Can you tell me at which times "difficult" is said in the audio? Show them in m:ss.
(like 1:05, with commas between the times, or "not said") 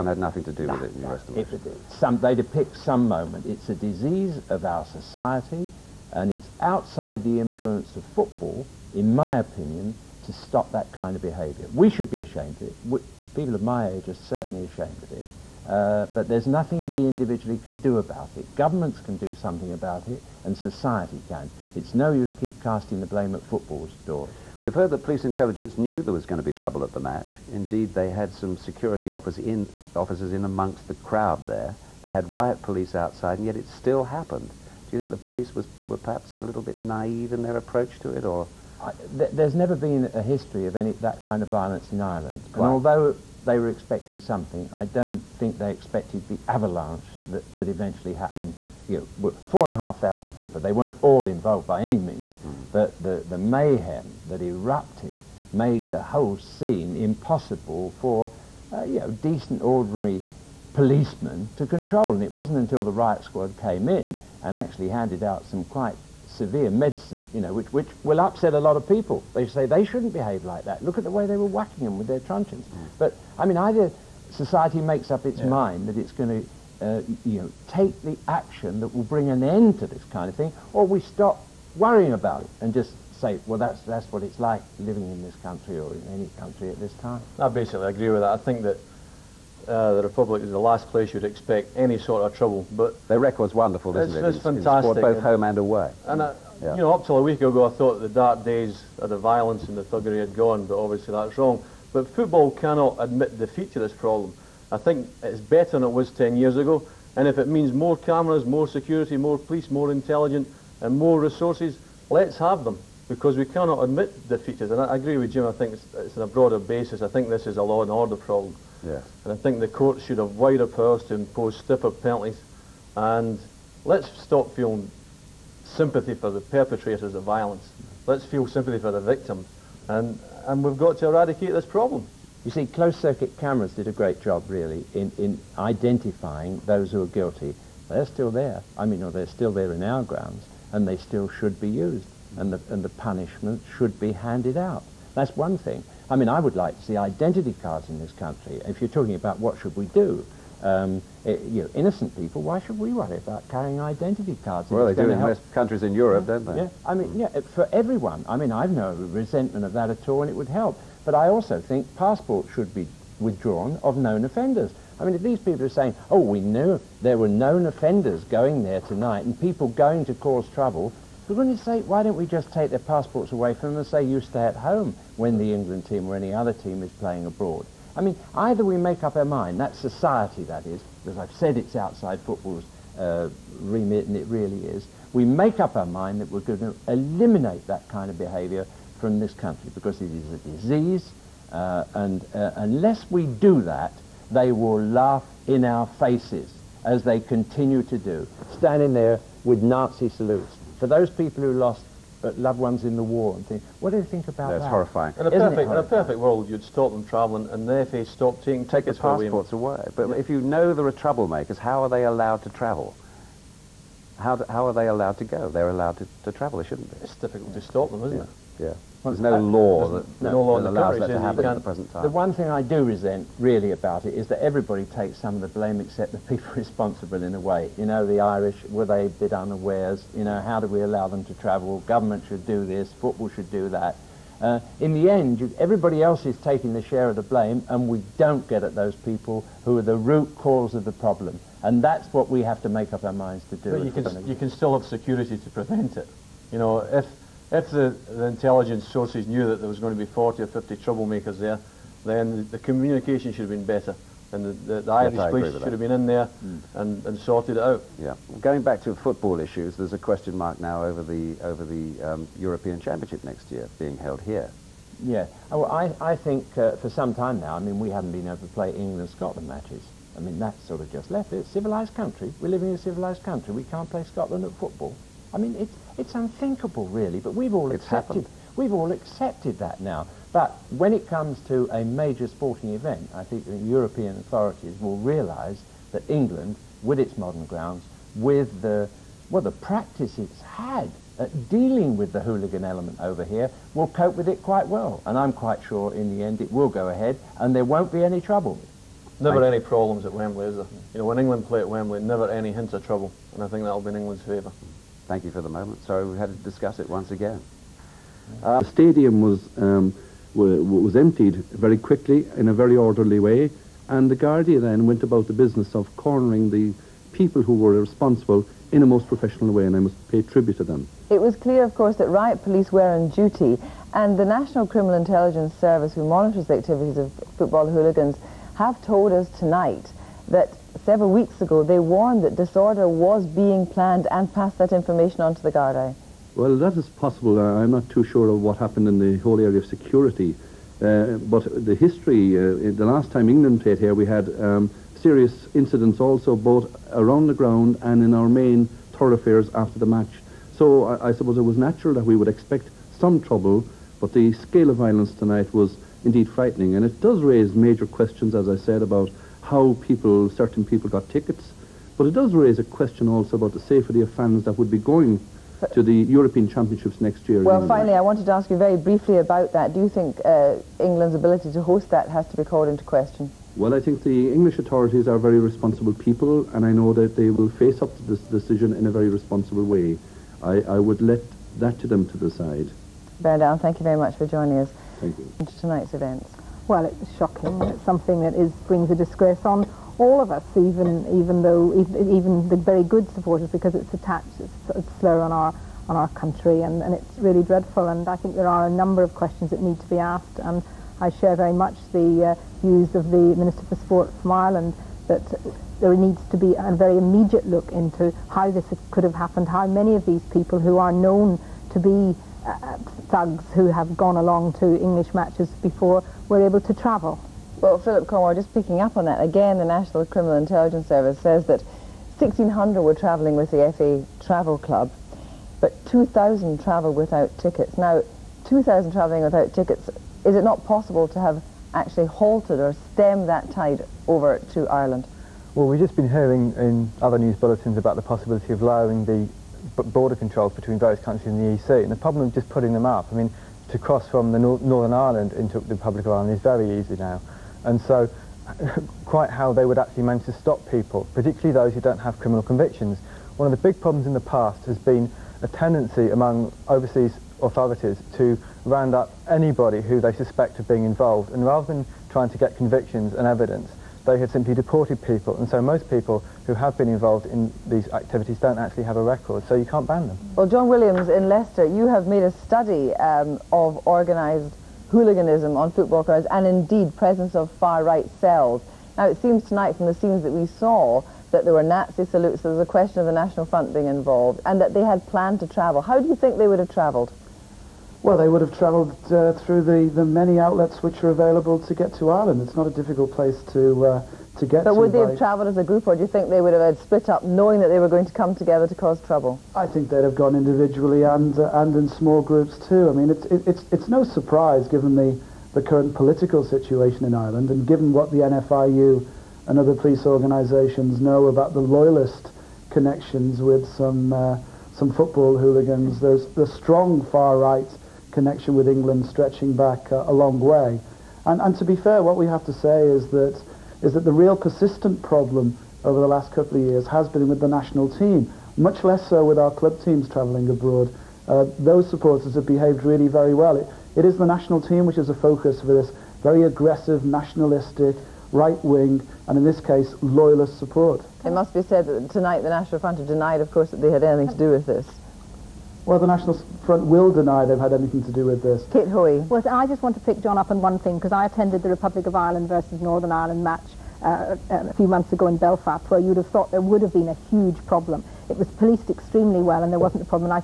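3:37, 8:12.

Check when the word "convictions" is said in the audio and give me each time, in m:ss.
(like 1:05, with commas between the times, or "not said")
7:32, 7:42.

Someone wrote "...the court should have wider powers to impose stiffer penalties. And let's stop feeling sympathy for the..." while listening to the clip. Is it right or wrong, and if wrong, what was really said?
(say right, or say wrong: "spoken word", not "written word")
right.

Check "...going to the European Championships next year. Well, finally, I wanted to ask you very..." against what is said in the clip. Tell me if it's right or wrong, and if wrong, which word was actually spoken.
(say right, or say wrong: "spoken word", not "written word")
right.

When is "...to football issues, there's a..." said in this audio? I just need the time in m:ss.
4:18.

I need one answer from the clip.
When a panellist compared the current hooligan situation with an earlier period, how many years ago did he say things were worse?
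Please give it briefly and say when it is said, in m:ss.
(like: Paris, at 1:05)
10 years, at 1:46.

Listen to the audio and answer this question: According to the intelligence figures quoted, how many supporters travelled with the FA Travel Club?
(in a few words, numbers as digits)
1,600.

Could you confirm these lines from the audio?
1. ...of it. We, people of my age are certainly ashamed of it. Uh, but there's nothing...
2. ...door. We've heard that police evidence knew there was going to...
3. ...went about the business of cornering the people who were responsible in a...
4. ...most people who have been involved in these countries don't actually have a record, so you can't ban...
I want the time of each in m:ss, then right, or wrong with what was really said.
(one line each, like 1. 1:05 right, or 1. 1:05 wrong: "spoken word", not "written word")
1. 0:12 right
2. 0:24 wrong: "intelligence", not "evidence"
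3. 5:14 right
4. 7:45 wrong: "activities", not "countries".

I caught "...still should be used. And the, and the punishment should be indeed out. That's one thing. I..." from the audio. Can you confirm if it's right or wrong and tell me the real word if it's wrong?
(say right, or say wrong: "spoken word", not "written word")
wrong: "handed", not "indeed".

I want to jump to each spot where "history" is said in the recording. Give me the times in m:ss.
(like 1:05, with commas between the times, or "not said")
0:40, 5:41.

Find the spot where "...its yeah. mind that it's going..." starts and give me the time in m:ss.
1:15.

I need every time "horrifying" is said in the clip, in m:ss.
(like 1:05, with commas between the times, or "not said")
3:24.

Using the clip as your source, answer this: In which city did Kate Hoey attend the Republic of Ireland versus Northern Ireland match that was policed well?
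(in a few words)
Belfast.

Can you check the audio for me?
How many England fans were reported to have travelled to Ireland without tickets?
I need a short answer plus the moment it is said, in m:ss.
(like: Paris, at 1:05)
2,000, at 7:05.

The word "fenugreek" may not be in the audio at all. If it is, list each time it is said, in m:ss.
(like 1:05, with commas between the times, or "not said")
not said.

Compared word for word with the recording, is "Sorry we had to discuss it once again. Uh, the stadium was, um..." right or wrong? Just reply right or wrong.
right.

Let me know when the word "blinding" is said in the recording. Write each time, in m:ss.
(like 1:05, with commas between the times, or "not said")
not said.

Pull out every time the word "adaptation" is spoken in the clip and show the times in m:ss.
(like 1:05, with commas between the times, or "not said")
not said.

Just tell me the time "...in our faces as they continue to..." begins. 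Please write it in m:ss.
3:15.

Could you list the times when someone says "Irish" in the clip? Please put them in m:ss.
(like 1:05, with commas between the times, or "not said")
3:48, 4:14.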